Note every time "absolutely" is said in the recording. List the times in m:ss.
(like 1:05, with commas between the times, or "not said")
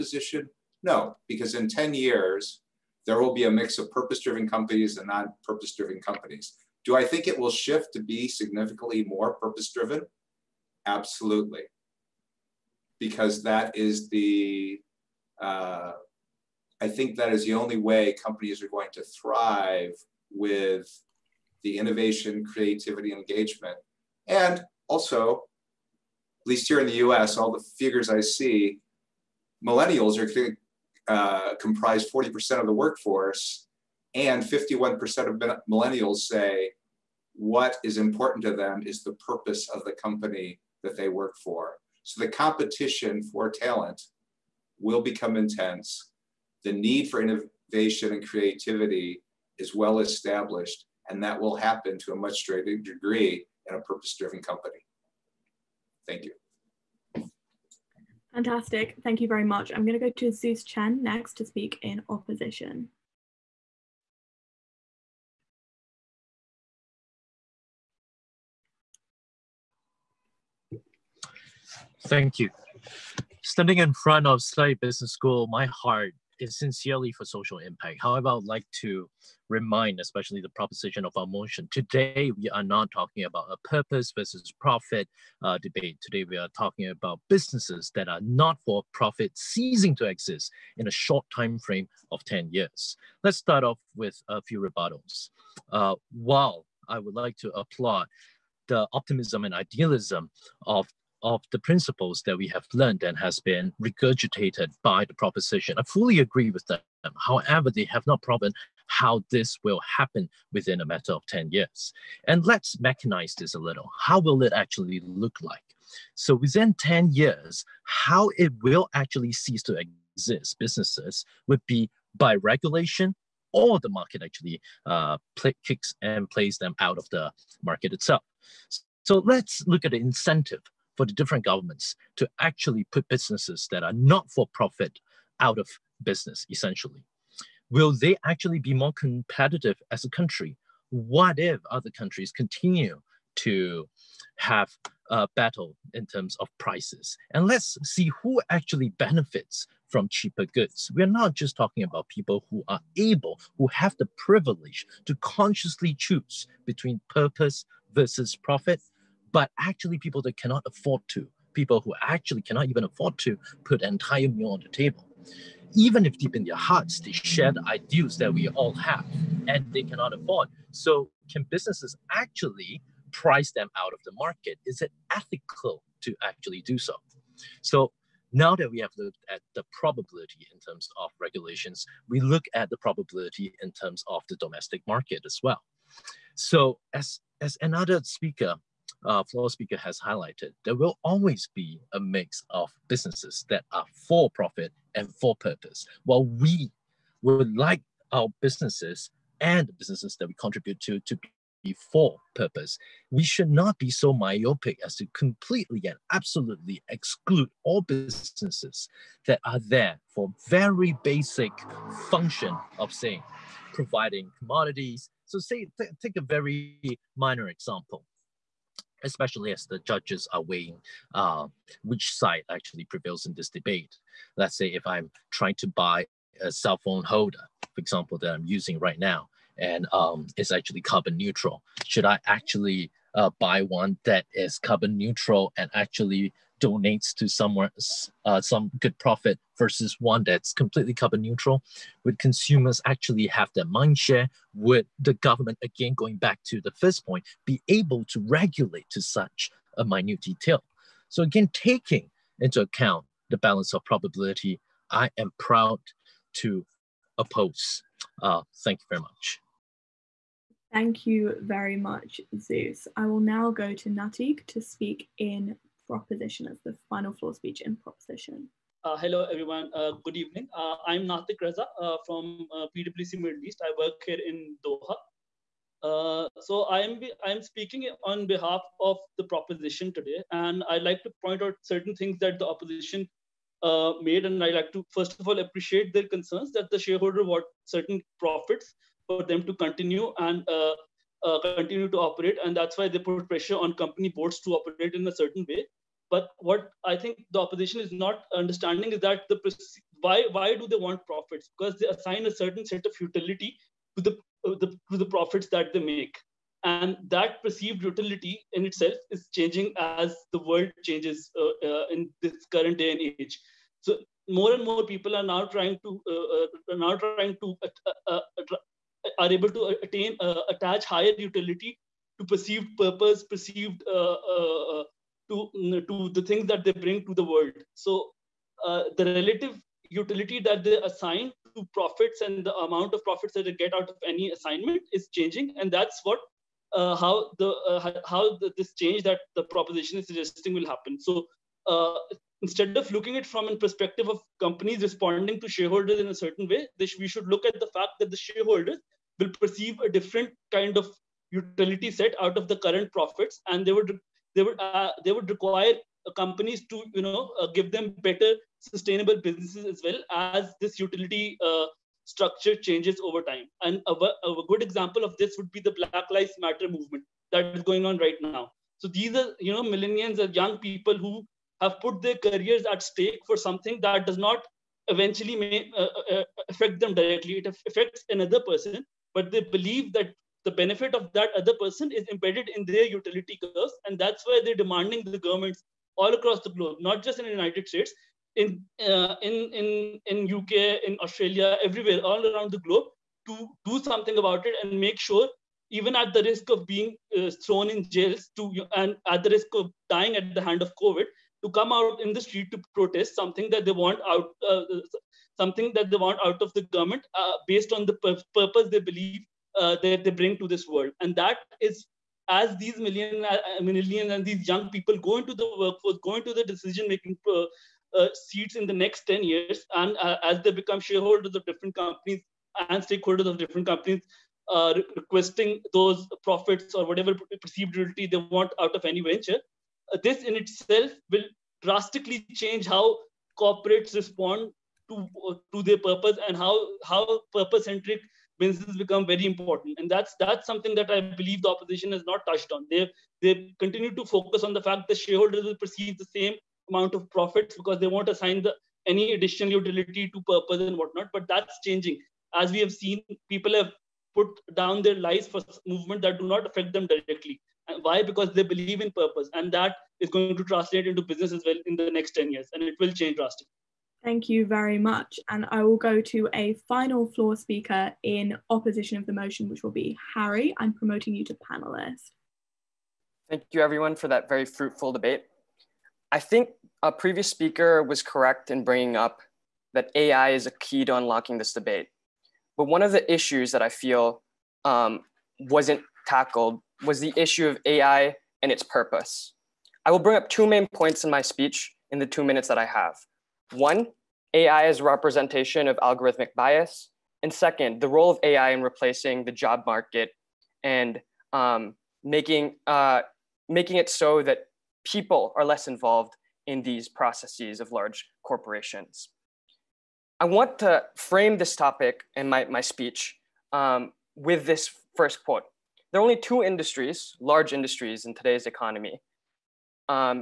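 0:10, 3:26.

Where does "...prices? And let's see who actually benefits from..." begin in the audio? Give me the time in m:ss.
2:26.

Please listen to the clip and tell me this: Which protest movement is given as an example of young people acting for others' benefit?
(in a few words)
Black Lives Matter.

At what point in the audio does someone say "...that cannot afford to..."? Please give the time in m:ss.
2:40.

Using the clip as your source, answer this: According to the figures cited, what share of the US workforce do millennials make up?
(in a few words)
40%.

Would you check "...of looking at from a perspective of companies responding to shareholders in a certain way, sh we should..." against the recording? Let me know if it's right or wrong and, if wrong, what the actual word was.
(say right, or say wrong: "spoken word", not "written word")
right.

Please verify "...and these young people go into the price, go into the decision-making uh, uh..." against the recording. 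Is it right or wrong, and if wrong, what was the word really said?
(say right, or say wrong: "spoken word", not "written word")
wrong: "workforce", not "price".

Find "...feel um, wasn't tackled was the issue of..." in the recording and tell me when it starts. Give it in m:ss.
8:03.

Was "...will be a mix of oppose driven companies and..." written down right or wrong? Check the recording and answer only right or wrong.
wrong.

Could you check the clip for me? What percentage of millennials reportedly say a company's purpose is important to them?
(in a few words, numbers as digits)
51%.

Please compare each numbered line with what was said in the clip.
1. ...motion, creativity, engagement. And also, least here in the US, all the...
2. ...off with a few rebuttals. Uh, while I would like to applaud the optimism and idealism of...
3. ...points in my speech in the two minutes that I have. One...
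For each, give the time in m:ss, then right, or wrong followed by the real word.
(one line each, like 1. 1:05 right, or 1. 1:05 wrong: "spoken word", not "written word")
1. 0:21 wrong: "innovation", not "motion"
2. 1:33 right
3. 8:10 right.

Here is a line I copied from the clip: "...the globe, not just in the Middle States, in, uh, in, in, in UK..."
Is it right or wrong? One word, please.
wrong.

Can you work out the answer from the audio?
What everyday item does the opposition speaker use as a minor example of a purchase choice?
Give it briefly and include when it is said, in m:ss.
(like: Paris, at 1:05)
cell phone holder, at 3:46.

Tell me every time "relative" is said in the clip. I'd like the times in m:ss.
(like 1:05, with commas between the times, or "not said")
5:29.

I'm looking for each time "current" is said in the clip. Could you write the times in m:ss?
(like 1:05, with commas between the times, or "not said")
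5:12, 5:52.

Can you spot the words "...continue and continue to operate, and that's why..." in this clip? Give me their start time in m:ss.
4:49.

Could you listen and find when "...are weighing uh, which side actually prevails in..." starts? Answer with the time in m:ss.
3:40.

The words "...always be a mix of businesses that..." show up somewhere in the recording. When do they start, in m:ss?
3:11.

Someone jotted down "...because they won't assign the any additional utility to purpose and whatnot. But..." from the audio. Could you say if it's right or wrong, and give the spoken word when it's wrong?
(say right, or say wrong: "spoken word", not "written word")
right.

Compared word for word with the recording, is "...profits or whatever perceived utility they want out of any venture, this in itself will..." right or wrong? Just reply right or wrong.
right.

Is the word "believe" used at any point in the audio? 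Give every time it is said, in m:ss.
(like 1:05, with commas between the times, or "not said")
6:19, 6:48, 7:21, 7:38.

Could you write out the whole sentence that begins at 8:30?
I want to frame this topic in my, my speech um, with this first quote.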